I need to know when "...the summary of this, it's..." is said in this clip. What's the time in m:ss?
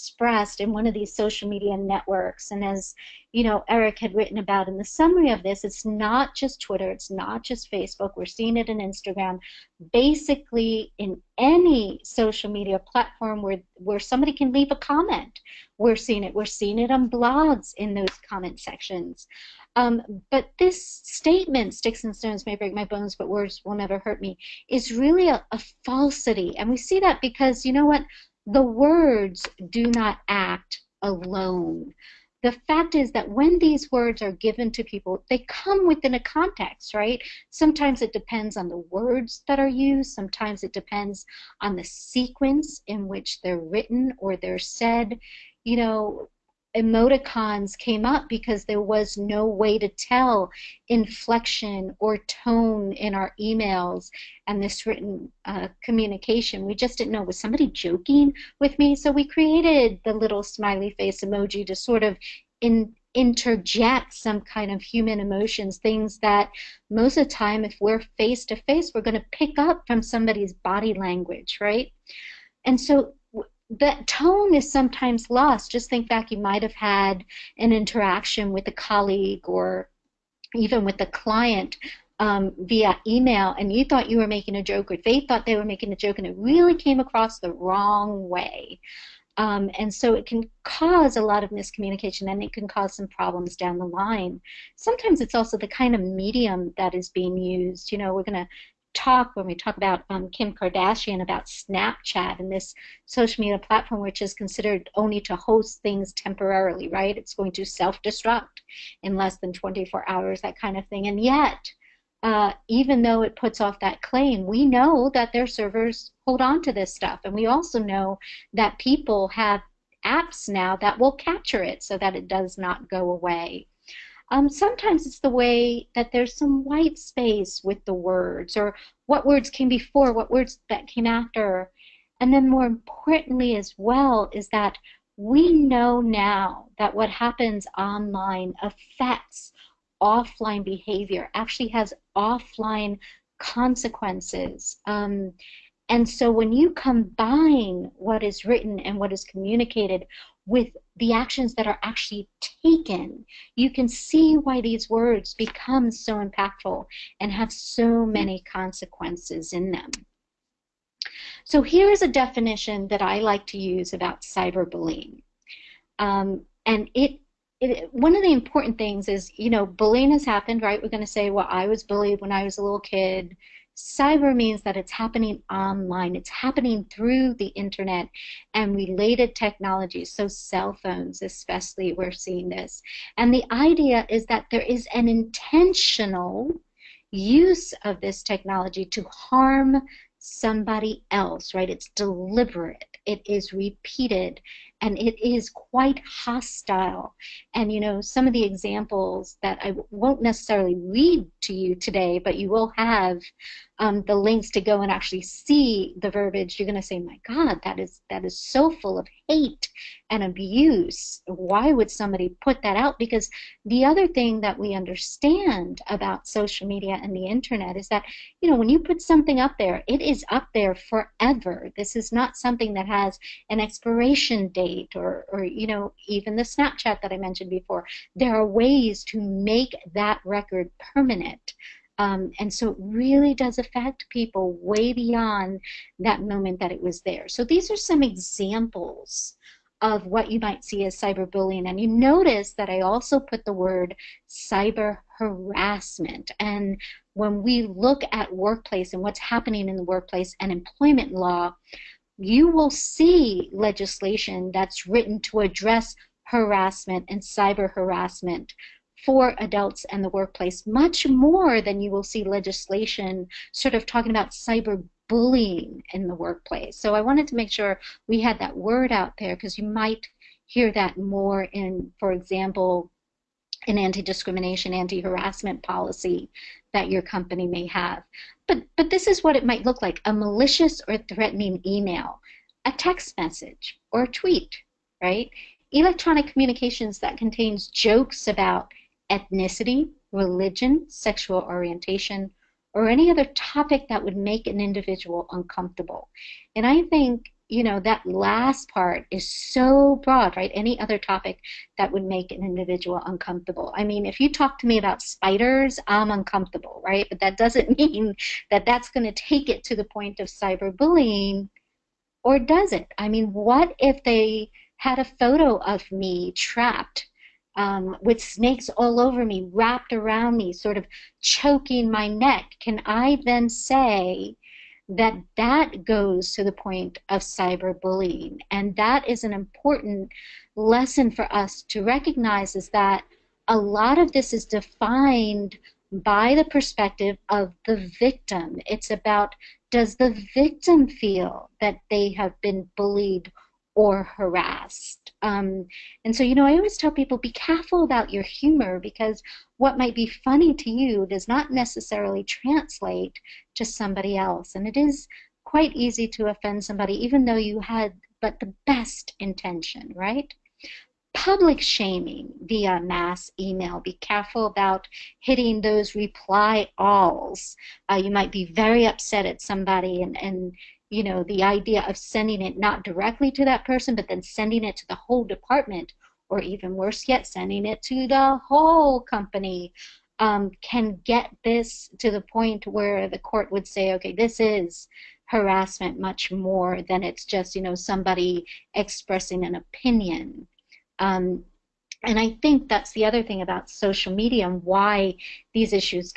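0:04.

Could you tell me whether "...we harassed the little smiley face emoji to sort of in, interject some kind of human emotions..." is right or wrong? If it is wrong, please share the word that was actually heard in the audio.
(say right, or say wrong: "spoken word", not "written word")
wrong: "created", not "harassed".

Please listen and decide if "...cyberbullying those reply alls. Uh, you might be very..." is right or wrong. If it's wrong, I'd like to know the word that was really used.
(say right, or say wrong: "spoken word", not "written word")
wrong: "hitting", not "cyberbullying".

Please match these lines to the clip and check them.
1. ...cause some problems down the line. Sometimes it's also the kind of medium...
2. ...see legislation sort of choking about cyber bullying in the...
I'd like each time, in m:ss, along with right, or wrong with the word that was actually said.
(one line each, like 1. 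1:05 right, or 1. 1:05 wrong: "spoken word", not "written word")
1. 1:32 right
2. 4:22 wrong: "talking", not "choking".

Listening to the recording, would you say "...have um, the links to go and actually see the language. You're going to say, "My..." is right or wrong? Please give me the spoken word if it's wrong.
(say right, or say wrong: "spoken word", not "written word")
wrong: "verbiage", not "language".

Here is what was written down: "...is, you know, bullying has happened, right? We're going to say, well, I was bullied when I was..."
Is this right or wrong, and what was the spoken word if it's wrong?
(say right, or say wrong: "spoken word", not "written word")
right.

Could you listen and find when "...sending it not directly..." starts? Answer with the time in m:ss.
6:11.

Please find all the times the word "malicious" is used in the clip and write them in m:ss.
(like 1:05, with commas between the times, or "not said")
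4:40.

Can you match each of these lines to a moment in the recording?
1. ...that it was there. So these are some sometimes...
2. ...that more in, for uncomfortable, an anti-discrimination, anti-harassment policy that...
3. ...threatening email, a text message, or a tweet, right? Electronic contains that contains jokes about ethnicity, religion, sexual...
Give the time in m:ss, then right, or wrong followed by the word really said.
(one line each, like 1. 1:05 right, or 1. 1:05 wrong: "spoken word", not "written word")
1. 3:56 wrong: "examples", not "sometimes"
2. 4:30 wrong: "example", not "uncomfortable"
3. 4:40 wrong: "communications", not "contains".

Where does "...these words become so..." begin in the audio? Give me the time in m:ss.
2:34.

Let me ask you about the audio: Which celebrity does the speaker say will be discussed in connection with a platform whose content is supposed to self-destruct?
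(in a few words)
Kim Kardashian.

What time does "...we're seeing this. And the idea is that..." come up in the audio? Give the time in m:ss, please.
3:01.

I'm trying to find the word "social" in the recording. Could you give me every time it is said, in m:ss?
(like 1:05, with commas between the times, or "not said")
0:01, 0:12, 1:43, 3:36, 6:33.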